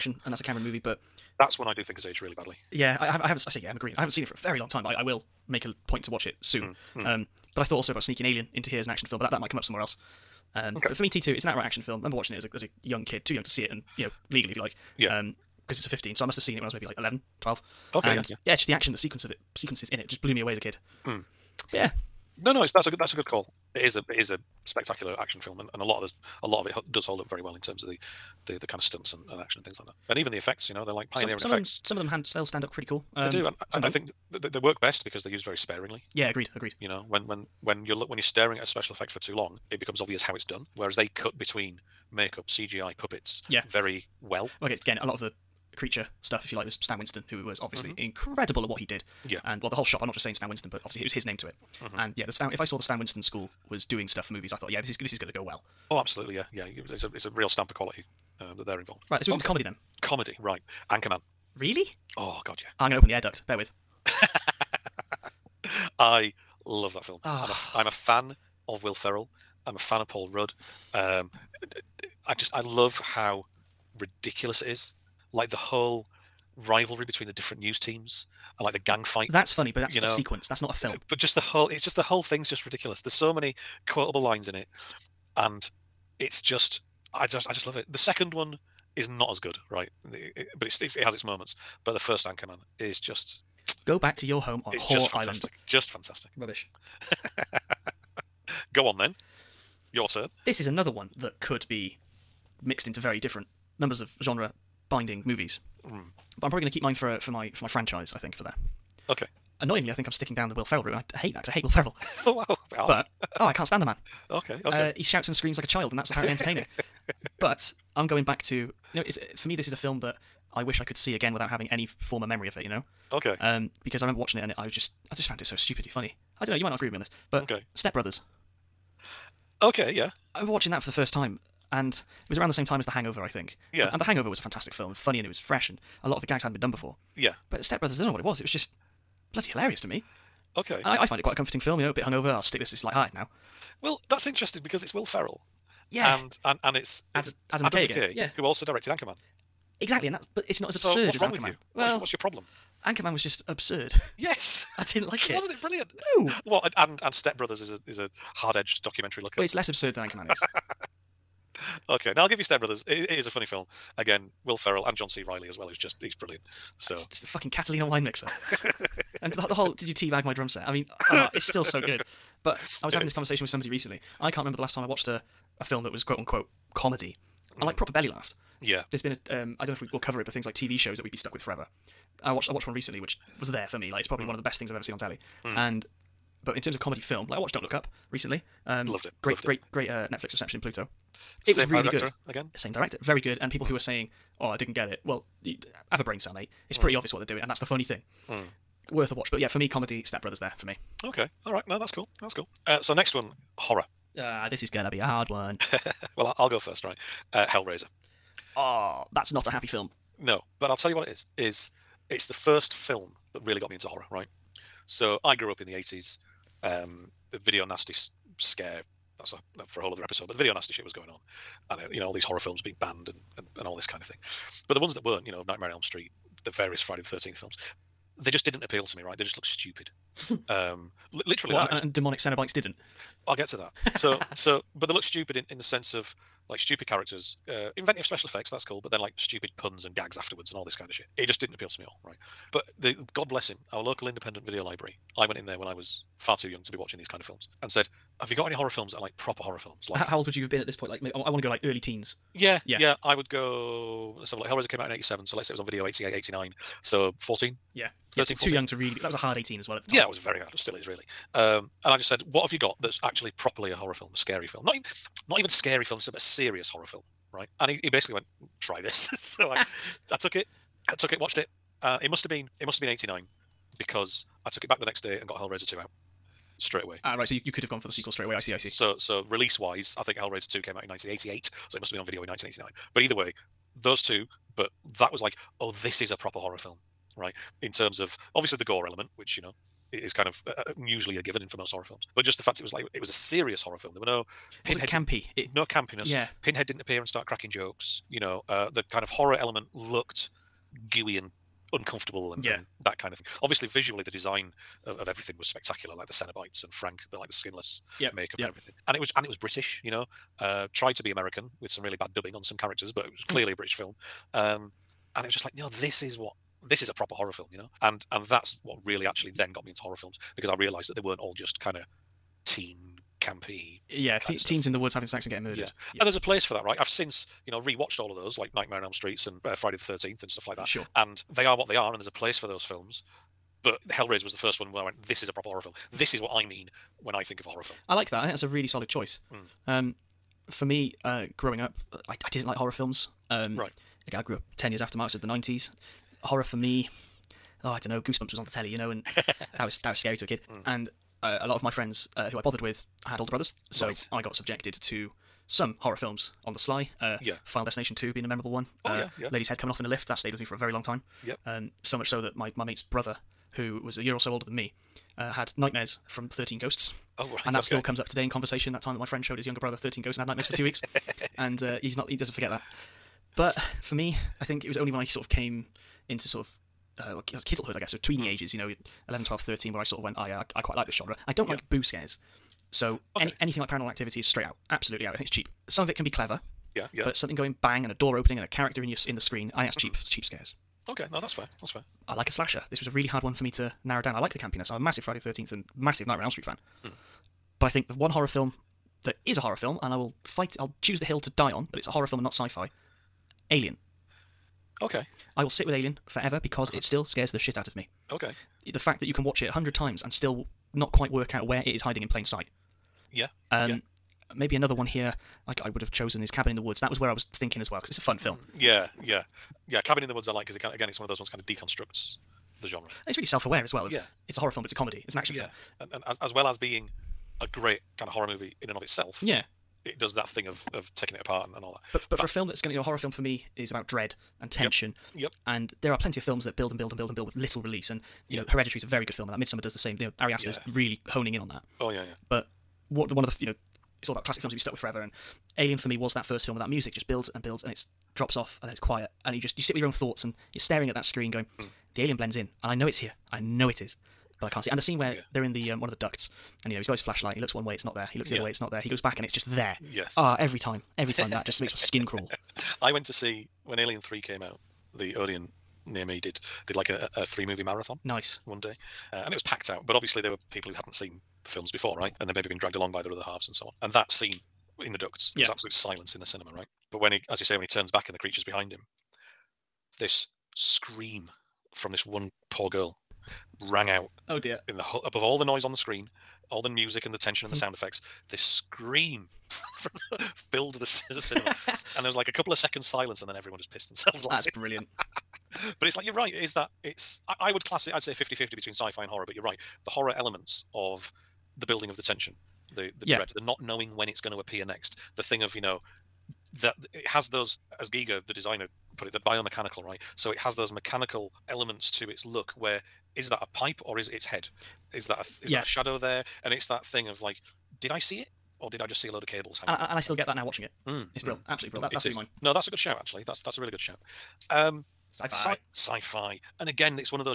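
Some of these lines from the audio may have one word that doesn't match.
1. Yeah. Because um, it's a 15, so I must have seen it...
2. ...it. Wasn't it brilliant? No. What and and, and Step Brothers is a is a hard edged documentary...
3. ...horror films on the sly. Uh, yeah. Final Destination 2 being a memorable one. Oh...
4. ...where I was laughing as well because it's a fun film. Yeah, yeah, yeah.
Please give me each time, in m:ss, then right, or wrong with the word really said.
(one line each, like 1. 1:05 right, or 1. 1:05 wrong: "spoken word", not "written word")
1. 0:14 right
2. 2:35 right
3. 5:55 right
4. 6:56 wrong: "thinking", not "laughing".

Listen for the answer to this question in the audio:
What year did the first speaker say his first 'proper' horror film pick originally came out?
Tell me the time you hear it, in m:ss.
4:14.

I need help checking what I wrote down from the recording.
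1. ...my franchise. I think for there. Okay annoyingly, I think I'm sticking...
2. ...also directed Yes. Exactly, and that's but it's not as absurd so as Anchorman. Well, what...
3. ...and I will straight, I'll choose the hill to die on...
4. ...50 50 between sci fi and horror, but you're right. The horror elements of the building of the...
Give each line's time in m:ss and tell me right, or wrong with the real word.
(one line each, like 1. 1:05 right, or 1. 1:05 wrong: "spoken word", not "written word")
1. 1:47 right
2. 2:28 wrong: "Anchorman", not "Yes"
3. 6:39 wrong: "fight", not "straight"
4. 8:18 right.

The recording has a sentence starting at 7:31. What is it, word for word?
the alien blends in and I know it's here.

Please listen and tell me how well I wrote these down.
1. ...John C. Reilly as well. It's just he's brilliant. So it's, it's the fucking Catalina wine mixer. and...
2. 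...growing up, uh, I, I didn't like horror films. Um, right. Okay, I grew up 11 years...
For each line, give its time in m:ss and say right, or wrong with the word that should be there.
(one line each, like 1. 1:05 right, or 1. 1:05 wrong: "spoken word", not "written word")
1. 2:44 right
2. 5:41 wrong: "10", not "11".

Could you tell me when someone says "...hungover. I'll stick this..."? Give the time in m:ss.
2:22.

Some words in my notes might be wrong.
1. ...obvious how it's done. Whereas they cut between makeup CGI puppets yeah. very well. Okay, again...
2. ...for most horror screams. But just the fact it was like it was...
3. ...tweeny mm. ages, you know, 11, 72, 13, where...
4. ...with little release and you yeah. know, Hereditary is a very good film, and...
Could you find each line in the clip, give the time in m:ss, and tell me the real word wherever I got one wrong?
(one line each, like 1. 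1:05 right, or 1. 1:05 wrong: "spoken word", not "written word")
1. 0:39 right
2. 4:51 wrong: "films", not "screams"
3. 6:18 wrong: "12", not "72"
4. 7:17 right.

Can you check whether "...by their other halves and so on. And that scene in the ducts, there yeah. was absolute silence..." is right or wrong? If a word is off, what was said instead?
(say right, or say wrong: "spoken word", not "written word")
right.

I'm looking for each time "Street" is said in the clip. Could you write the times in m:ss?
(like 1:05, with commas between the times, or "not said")
3:45, 5:28, 6:36.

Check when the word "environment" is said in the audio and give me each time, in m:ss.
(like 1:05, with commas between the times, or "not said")
not said.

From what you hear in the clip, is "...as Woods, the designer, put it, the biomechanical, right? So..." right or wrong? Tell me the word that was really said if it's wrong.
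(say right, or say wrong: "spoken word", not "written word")
wrong: "Giger", not "Woods".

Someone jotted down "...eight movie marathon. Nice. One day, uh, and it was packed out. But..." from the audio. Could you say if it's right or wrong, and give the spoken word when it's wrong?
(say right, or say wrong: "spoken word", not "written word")
wrong: "three", not "eight".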